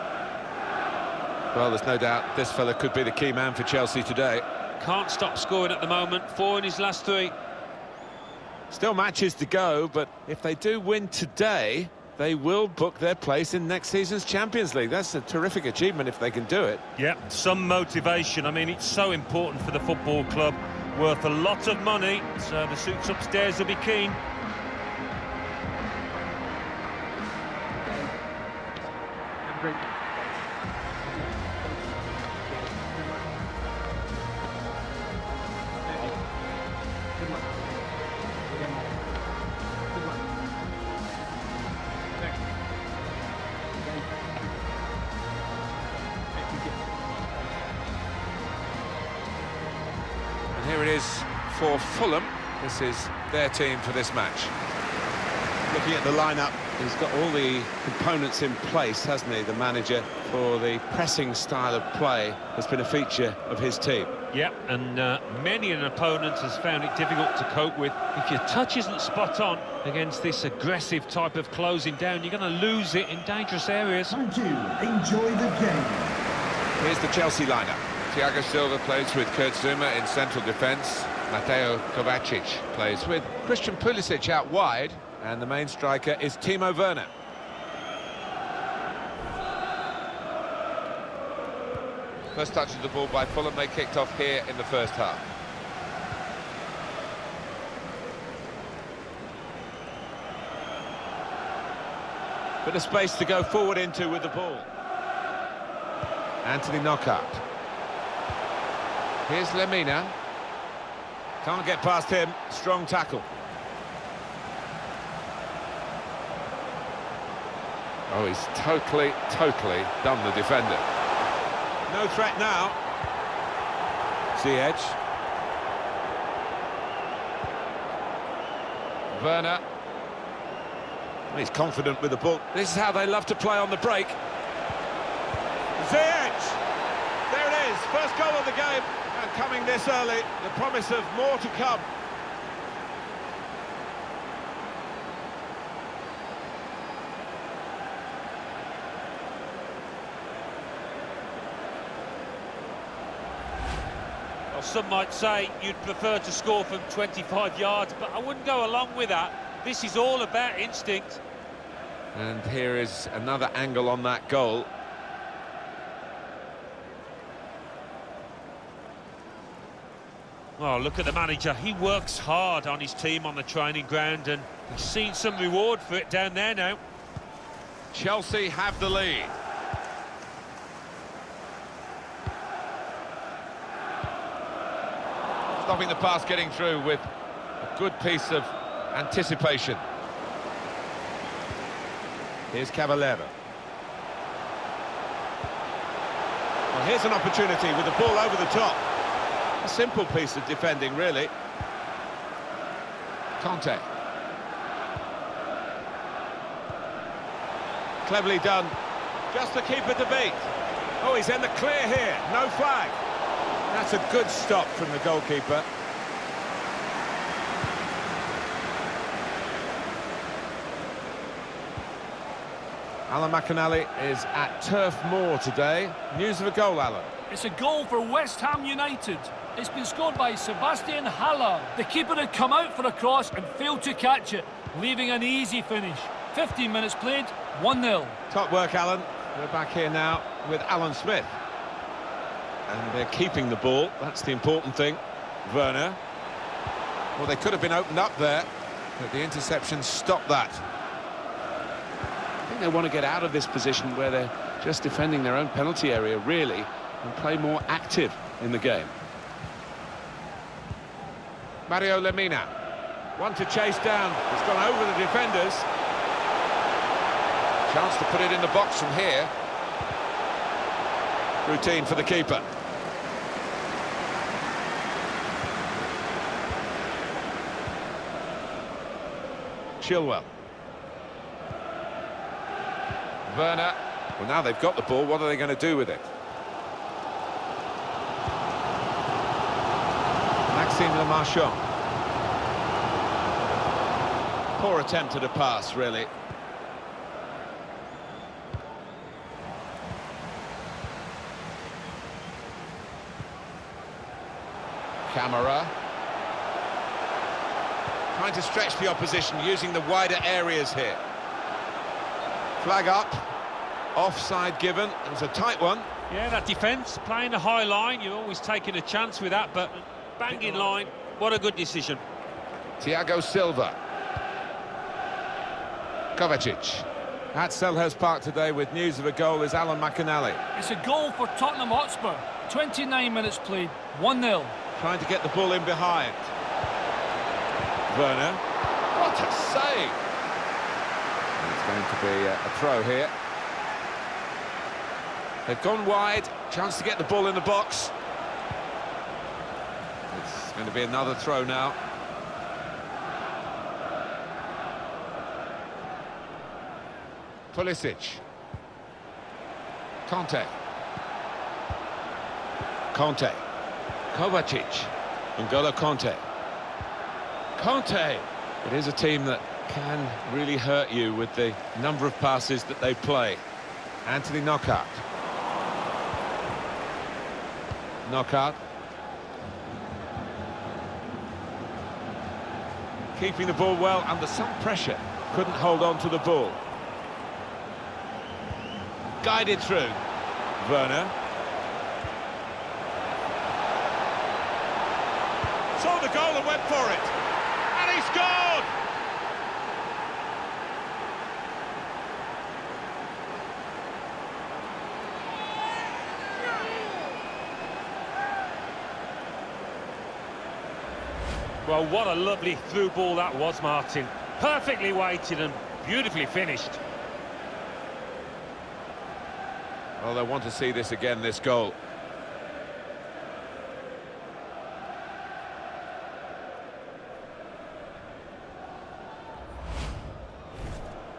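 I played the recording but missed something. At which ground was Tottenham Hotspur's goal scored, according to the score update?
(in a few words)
Selhurst Park.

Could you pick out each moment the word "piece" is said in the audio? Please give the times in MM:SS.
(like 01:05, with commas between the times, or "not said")
03:07, 03:20.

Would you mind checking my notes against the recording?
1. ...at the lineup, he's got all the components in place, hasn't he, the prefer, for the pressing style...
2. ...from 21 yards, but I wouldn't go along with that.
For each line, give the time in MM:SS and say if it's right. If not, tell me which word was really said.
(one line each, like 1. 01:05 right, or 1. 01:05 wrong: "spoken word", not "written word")
1. 00:55 wrong: "manager", not "prefer"
2. 02:36 wrong: "25", not "21".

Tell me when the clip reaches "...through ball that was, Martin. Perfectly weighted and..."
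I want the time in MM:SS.
06:52.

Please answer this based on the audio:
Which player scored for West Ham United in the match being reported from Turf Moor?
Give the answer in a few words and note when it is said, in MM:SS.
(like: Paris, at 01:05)
Sebastian Haller, at 03:50.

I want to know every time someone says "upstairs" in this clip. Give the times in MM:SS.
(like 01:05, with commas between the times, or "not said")
00:23.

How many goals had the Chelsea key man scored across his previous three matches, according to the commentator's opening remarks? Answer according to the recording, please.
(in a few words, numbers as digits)
4.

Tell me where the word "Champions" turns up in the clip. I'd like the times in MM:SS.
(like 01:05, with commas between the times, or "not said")
00:14.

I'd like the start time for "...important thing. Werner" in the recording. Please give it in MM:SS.
04:04.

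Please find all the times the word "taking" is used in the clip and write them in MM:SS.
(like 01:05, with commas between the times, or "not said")
05:18.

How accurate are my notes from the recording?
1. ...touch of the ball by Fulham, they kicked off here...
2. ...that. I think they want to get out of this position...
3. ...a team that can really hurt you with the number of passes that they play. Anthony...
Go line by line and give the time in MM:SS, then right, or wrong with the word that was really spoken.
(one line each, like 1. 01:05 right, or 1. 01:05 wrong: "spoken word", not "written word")
1. 01:32 right
2. 04:10 right
3. 06:08 right.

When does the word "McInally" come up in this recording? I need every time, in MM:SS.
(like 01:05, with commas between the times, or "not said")
03:43, 05:29.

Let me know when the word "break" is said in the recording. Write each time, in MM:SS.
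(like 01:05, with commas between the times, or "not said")
02:13.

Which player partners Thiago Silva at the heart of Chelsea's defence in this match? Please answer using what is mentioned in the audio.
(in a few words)
Kurt Zouma.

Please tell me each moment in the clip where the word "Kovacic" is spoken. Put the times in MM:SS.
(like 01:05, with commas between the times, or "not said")
01:21, 05:26, 06:04.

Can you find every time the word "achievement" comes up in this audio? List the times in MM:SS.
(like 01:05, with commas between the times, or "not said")
00:15.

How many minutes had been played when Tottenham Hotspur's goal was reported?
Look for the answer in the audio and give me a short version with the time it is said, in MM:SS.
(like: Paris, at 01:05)
29, at 05:32.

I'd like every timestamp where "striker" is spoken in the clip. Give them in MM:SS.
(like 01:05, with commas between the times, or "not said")
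01:25.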